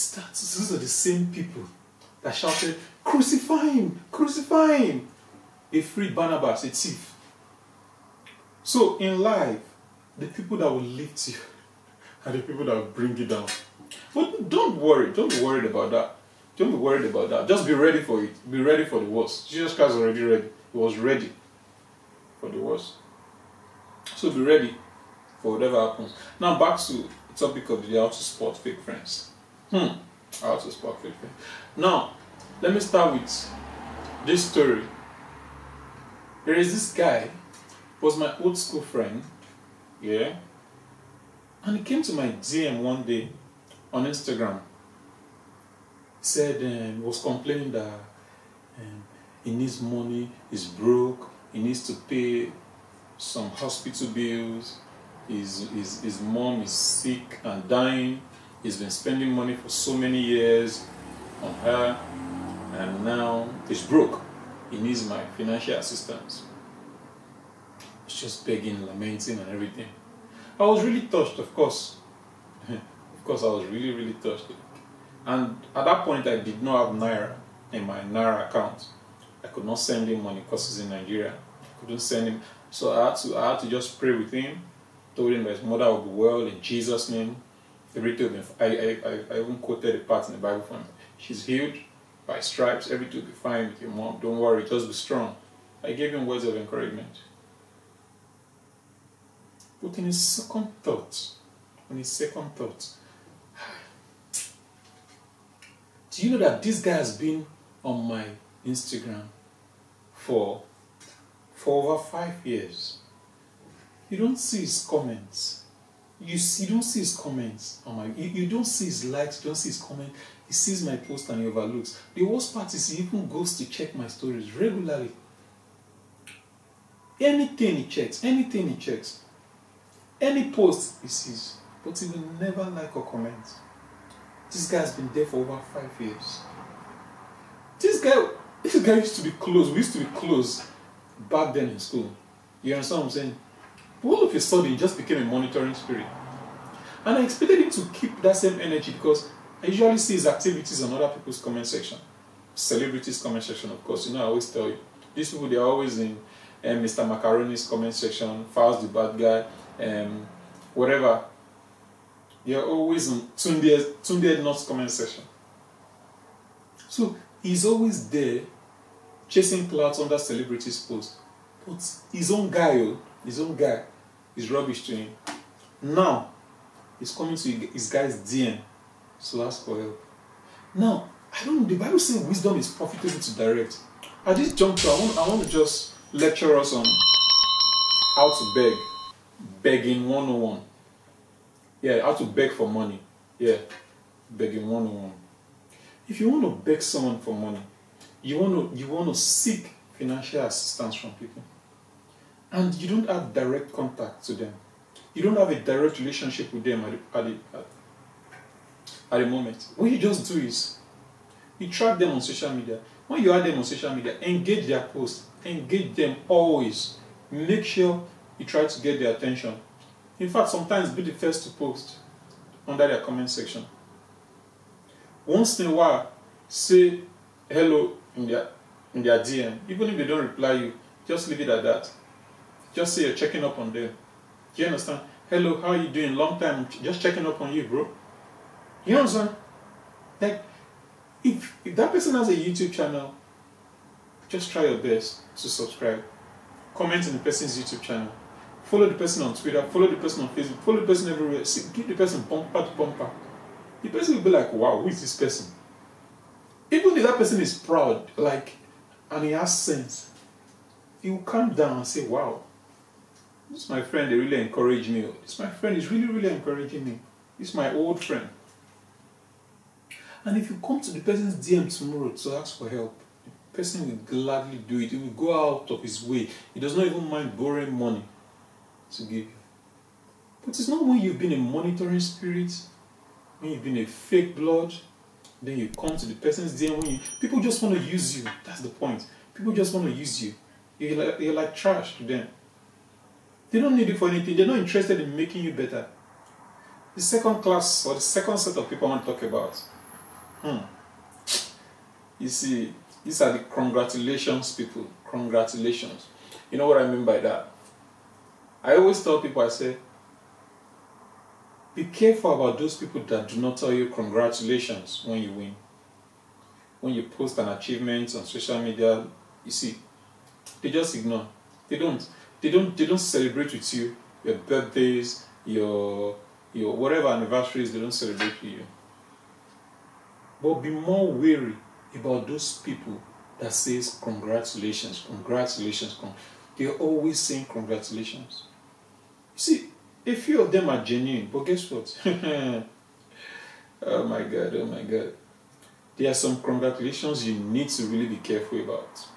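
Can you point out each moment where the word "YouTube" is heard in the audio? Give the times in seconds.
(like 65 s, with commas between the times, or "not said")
242 s, 247 s.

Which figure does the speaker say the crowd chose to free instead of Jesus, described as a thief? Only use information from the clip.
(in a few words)
Barnabas.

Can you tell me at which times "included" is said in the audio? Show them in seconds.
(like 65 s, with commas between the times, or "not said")
not said.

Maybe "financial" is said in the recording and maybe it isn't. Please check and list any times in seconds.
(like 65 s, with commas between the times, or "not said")
65 s, 199 s.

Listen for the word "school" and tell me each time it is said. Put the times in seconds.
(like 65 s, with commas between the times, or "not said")
38 s, 141 s.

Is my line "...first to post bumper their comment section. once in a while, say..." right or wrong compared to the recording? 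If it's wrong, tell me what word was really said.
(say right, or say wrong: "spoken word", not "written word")
wrong: "under", not "bumper".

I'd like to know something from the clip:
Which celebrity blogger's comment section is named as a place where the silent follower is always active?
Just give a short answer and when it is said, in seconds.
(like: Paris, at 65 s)
Tunde Ednut, at 163 s.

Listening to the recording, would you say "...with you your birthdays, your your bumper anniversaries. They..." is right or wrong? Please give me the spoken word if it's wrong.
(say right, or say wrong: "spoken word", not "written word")
wrong: "whatever", not "bumper".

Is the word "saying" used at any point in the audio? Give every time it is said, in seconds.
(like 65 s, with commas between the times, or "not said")
143 s, 239 s, 337 s.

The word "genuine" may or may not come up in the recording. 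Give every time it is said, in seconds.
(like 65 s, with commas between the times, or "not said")
340 s.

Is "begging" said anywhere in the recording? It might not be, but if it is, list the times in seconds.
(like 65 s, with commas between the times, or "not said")
68 s, 189 s, 194 s.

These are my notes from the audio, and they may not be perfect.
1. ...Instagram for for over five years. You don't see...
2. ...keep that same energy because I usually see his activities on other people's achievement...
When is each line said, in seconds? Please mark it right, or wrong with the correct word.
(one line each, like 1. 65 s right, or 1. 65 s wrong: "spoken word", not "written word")
1. 108 s right
2. 147 s wrong: "comment", not "achievement".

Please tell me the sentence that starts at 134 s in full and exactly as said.
This guy's been there for over five years.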